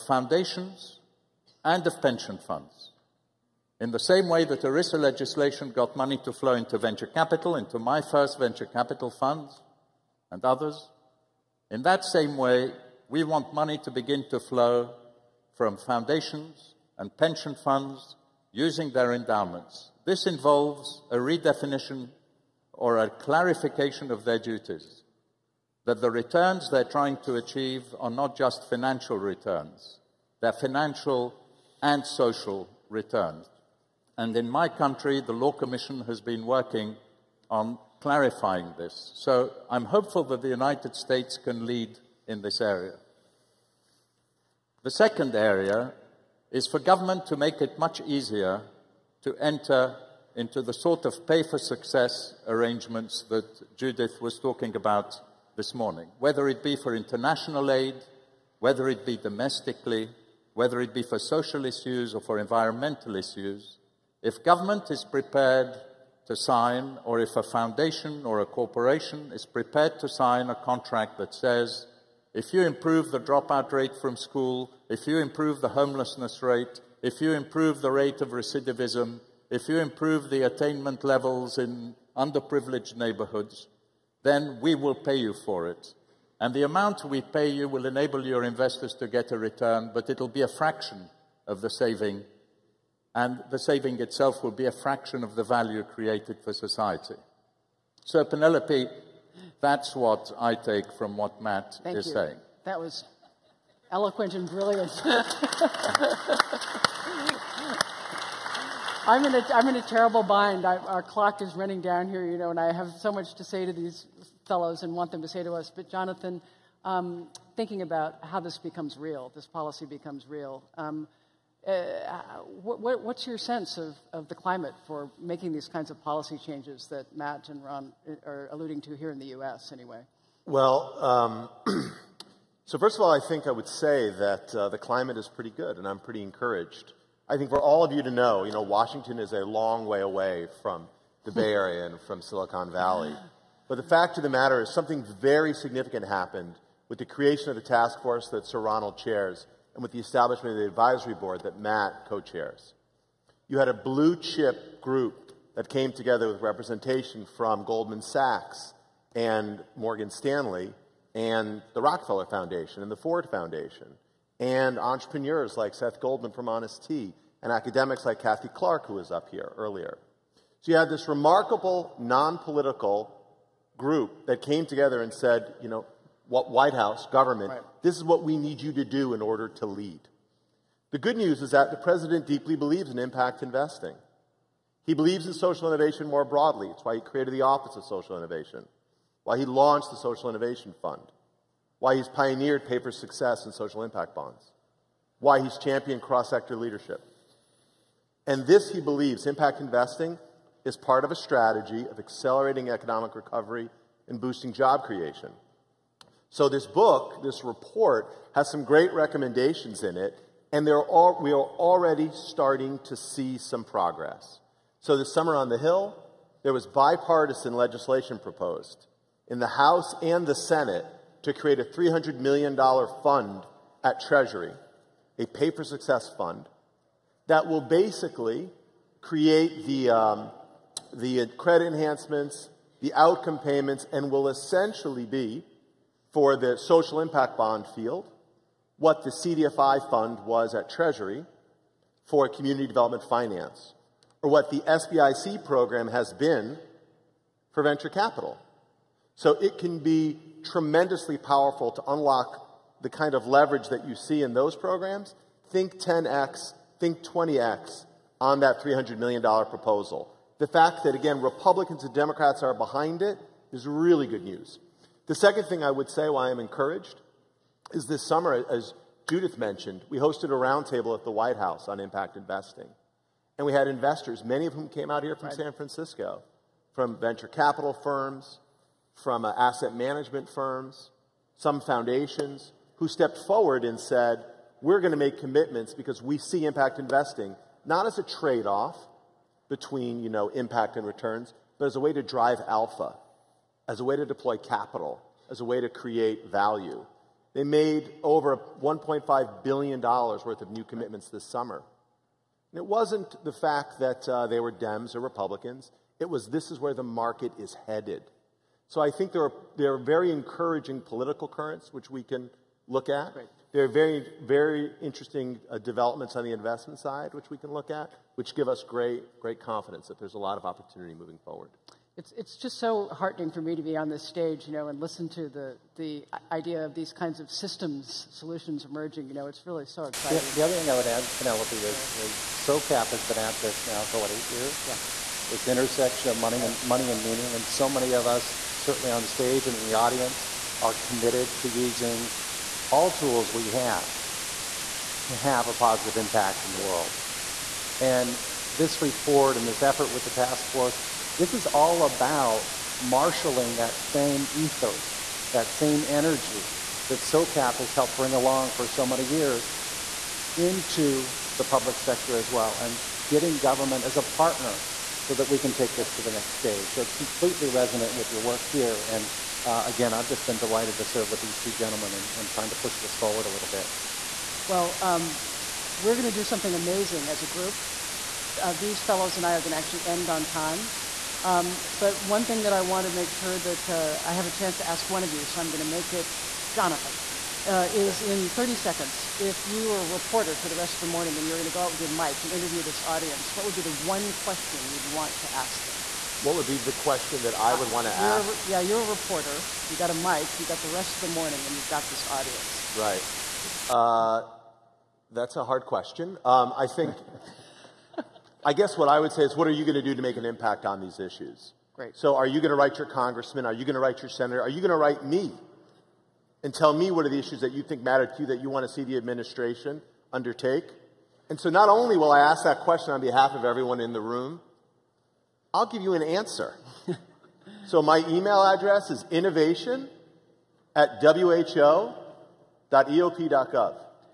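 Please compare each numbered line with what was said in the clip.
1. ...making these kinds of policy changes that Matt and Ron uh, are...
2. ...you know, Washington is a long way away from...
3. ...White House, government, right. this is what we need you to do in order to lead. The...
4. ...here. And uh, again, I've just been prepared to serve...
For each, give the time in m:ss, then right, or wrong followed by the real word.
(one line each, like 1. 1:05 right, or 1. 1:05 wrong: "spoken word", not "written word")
1. 2:05 right
2. 2:18 right
3. 2:56 right
4. 6:08 wrong: "delighted", not "prepared".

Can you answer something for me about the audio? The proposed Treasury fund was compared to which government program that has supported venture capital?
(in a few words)
SBIC program.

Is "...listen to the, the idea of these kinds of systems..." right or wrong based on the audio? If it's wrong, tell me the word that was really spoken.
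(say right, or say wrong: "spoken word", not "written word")
right.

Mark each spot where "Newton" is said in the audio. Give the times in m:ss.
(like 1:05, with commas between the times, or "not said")
not said.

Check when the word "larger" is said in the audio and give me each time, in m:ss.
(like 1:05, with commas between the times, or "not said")
not said.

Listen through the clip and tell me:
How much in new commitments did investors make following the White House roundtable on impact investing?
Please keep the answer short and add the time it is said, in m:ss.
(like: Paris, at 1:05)
$1.5 billion, at 4:58.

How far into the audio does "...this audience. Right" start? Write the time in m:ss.
6:41.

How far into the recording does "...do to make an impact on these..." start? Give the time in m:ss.
6:49.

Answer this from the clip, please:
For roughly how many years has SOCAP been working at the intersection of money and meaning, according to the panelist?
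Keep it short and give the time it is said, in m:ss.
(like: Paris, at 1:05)
8, at 5:34.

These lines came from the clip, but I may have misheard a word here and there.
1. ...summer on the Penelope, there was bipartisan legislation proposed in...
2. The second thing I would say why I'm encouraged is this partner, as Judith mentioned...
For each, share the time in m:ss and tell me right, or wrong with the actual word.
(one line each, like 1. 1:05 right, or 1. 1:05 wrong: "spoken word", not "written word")
1. 3:35 wrong: "Hill", not "Penelope"
2. 4:25 wrong: "summer", not "partner".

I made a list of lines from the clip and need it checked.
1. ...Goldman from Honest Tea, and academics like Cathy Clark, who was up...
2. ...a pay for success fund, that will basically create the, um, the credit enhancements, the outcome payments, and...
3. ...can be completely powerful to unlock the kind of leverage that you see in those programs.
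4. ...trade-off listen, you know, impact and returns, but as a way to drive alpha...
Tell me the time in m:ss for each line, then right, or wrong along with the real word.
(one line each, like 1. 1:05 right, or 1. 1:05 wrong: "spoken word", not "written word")
1. 2:46 right
2. 3:45 right
3. 4:09 wrong: "tremendously", not "completely"
4. 4:48 wrong: "between", not "listen".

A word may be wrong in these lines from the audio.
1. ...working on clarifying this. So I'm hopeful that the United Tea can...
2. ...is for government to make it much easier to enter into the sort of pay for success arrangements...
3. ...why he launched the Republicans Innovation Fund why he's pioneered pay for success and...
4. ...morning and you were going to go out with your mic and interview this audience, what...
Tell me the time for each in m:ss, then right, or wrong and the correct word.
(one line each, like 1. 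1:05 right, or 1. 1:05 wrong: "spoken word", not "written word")
1. 0:36 wrong: "States", not "Tea"
2. 0:46 right
3. 3:09 wrong: "Social", not "Republicans"
4. 6:30 right.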